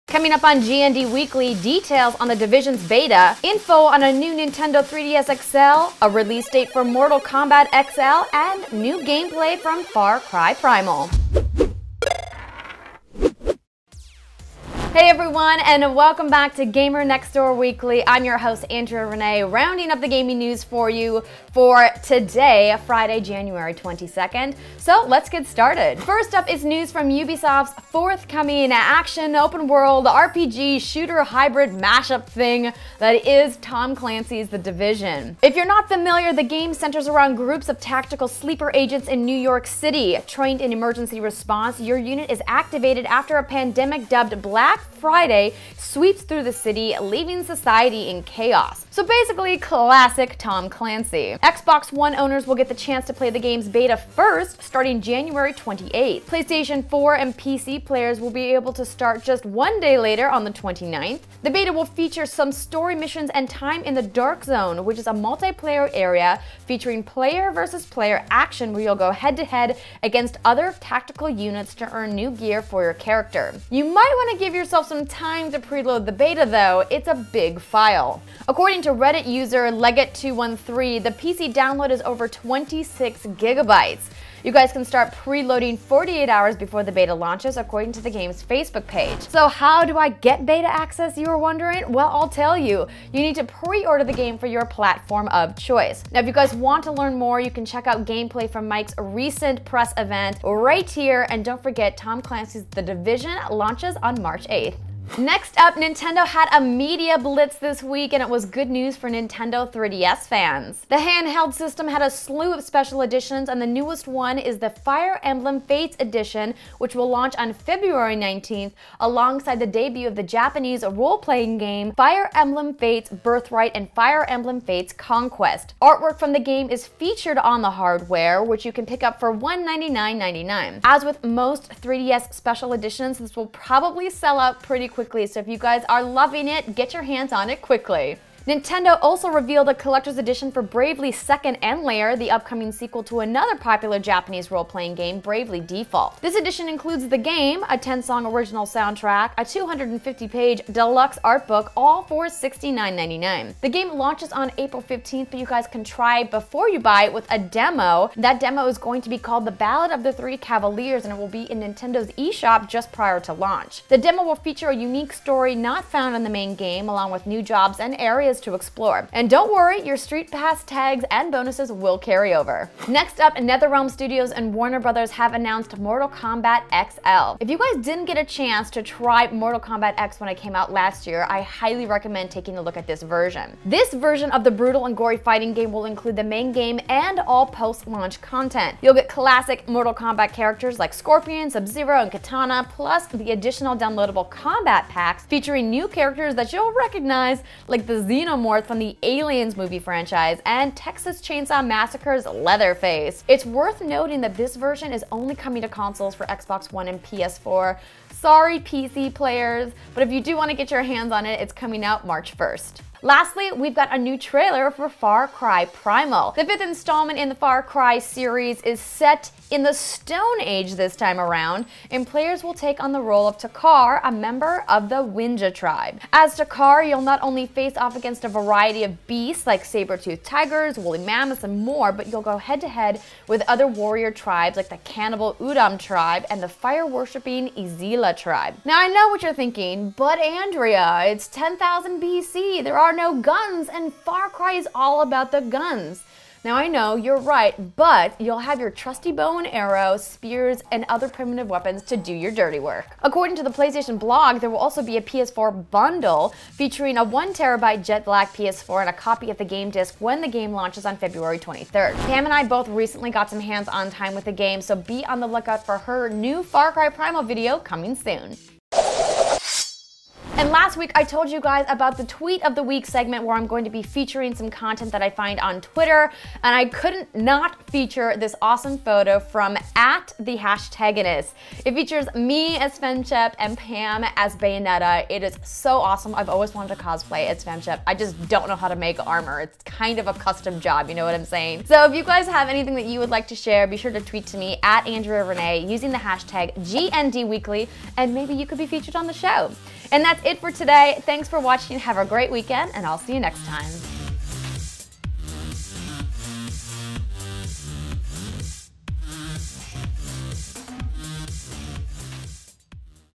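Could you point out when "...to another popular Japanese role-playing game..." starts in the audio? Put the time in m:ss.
2:23.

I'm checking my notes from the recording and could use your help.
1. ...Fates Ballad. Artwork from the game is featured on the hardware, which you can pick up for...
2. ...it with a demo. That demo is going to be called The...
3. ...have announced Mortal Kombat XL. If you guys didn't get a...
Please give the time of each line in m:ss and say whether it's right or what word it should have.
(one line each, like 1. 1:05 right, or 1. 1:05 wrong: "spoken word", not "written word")
1. 2:04 wrong: "Conquest", not "Ballad"
2. 2:37 right
3. 2:55 right.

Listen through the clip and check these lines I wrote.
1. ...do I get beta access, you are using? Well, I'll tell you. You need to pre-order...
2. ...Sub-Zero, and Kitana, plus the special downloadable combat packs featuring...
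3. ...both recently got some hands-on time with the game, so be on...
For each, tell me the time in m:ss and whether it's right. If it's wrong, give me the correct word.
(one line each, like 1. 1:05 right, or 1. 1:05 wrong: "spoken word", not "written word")
1. 1:29 wrong: "wondering", not "using"
2. 3:11 wrong: "additional", not "special"
3. 4:22 right.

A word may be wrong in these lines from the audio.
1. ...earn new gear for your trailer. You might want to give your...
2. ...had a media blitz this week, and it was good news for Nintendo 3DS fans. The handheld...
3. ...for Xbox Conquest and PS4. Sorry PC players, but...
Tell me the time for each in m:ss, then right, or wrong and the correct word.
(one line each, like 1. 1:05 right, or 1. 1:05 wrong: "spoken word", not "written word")
1. 1:11 wrong: "character", not "trailer"
2. 1:46 right
3. 3:26 wrong: "One", not "Conquest".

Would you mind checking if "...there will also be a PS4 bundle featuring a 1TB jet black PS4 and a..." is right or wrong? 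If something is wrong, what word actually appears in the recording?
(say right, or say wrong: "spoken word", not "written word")
right.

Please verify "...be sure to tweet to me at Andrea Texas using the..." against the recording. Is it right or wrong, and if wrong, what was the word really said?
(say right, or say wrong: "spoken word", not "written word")
wrong: "Rene", not "Texas".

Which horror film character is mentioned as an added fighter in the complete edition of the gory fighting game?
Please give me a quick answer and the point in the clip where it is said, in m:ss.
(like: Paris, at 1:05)
Leatherface, at 3:22.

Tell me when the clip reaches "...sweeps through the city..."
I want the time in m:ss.
0:45.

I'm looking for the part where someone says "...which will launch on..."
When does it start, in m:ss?
1:56.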